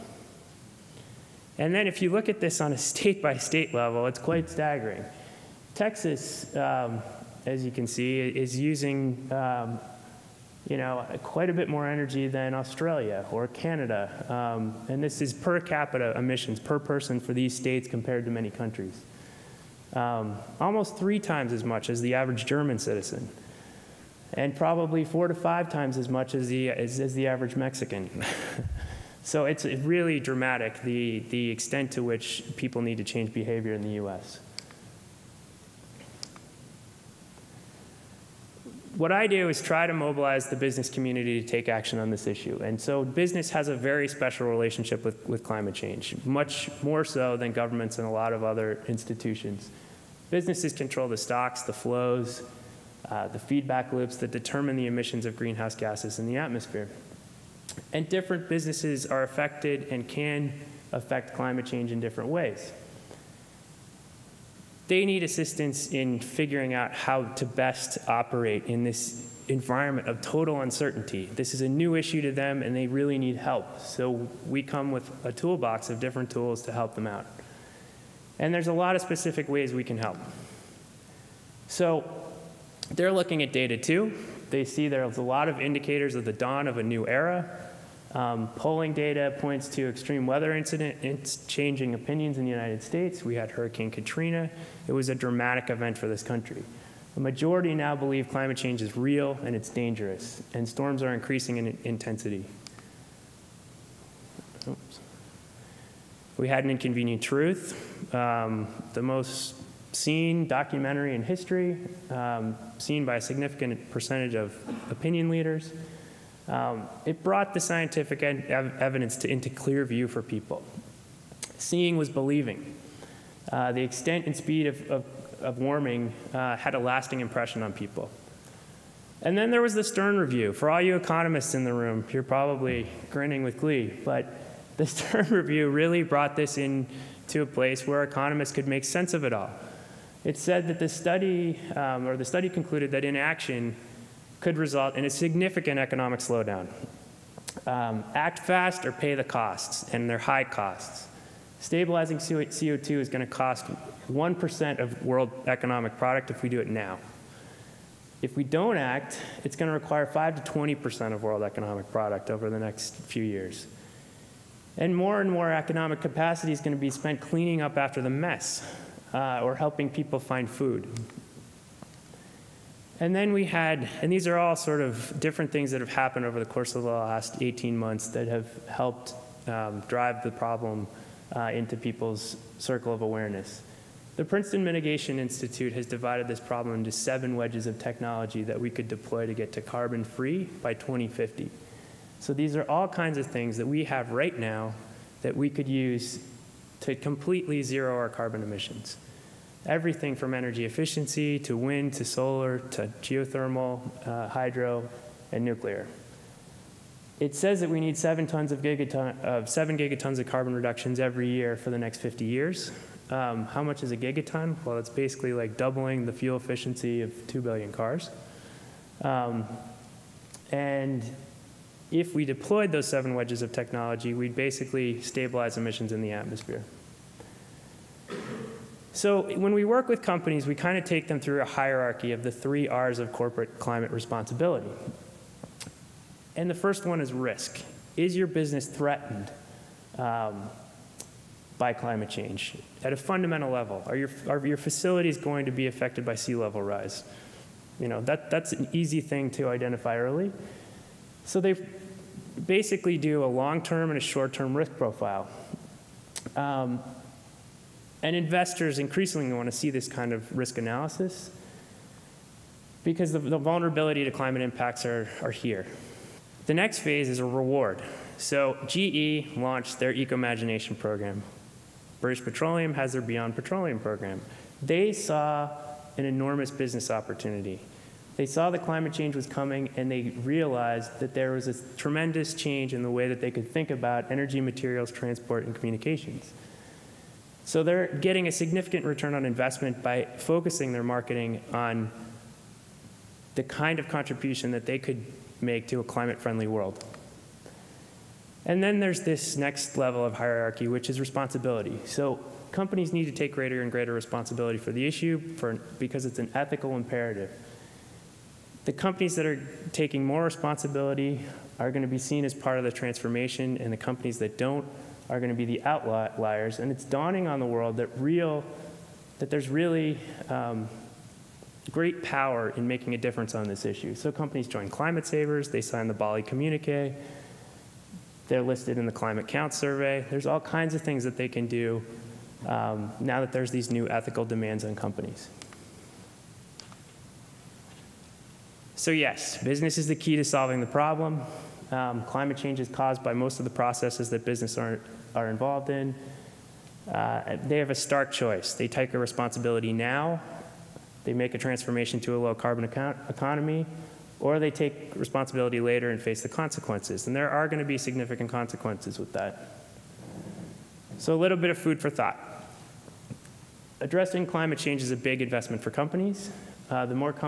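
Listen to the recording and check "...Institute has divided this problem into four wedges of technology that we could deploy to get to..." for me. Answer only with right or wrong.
wrong.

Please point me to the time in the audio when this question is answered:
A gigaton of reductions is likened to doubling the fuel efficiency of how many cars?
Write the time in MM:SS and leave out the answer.
03:37.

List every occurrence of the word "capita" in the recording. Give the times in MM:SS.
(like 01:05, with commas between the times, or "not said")
00:15.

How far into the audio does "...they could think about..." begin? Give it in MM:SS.
04:43.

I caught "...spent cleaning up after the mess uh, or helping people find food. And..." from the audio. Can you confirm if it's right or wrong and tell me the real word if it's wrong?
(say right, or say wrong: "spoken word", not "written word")
right.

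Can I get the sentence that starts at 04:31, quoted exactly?
British Petroleum has their Beyond Petroleum program.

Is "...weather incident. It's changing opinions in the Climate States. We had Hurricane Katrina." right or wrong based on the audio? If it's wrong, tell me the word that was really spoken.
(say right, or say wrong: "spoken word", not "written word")
wrong: "United", not "Climate".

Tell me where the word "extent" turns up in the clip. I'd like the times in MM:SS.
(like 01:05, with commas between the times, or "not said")
00:31, 02:03.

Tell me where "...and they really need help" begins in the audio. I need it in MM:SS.
01:12.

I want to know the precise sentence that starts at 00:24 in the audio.
And probably four to five times as much as the, as, as the average Mexican.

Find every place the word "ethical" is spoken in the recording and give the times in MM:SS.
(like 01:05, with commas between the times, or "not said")
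05:06, 05:33.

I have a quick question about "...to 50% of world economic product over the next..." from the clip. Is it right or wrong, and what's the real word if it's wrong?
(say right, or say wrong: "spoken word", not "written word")
wrong: "20", not "50".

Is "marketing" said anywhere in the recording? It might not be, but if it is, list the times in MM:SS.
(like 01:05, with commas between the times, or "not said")
04:50.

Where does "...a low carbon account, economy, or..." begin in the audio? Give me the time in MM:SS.
05:52.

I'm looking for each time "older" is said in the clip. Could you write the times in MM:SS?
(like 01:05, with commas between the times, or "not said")
not said.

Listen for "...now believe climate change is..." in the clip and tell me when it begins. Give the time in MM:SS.
01:37.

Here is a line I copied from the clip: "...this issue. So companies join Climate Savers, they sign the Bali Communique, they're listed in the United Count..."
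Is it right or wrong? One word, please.
wrong.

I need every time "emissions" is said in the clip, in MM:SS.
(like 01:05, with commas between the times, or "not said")
00:16, 00:54, 03:18, 03:45.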